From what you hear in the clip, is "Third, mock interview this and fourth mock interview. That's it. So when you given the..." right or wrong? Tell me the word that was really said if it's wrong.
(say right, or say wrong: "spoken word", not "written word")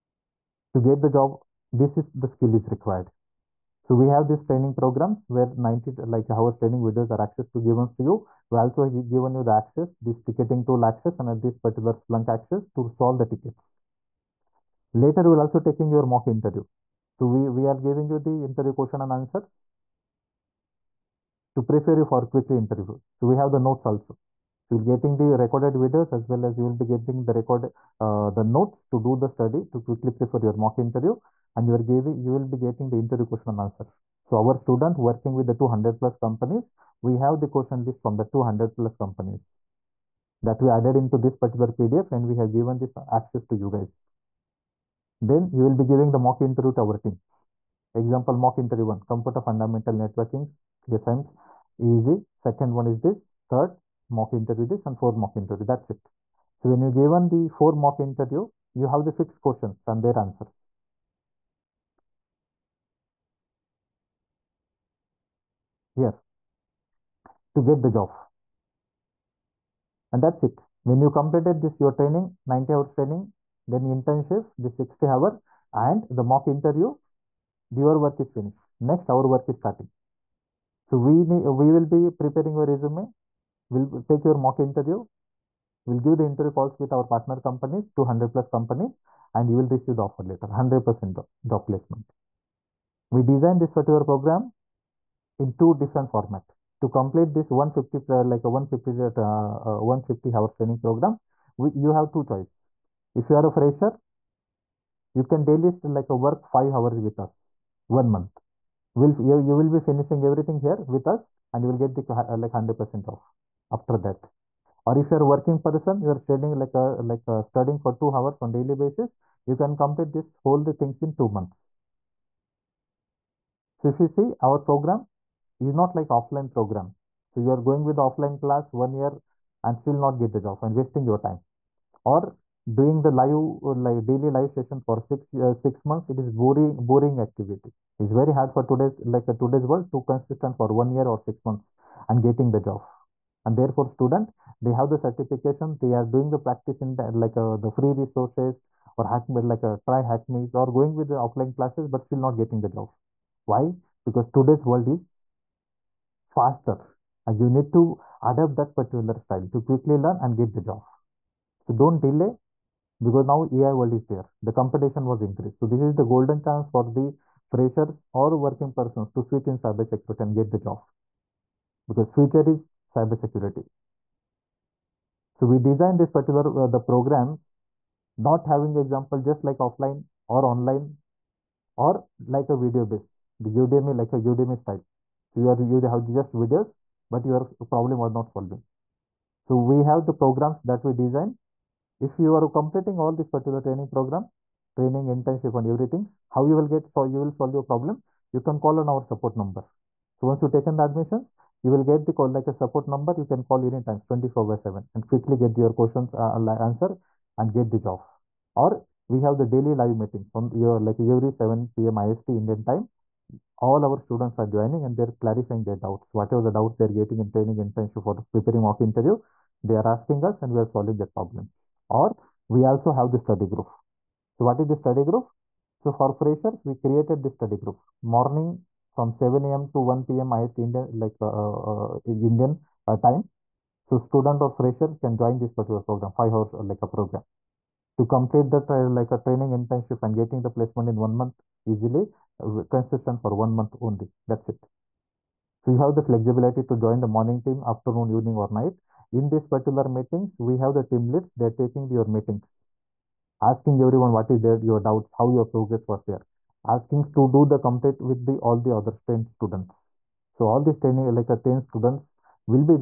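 right.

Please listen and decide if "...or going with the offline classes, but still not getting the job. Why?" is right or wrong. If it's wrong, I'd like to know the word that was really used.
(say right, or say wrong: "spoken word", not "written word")
right.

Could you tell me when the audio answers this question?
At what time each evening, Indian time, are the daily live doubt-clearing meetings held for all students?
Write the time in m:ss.
3:31.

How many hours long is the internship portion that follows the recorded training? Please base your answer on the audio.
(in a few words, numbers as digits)
60 hours.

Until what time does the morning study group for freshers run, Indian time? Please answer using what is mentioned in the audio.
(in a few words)
1 p.m.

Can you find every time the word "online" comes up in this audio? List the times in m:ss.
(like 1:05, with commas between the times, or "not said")
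3:00.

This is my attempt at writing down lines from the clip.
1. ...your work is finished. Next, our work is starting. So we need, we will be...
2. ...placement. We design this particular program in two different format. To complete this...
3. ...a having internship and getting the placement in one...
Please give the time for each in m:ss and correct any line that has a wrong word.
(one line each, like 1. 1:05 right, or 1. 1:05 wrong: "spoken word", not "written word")
1. 1:17 right
2. 1:31 right
3. 3:59 wrong: "training", not "having".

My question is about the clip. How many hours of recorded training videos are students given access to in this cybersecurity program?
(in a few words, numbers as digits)
90.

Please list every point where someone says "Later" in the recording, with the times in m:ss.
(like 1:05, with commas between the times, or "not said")
0:14.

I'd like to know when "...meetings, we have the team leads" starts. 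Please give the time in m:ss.
4:09.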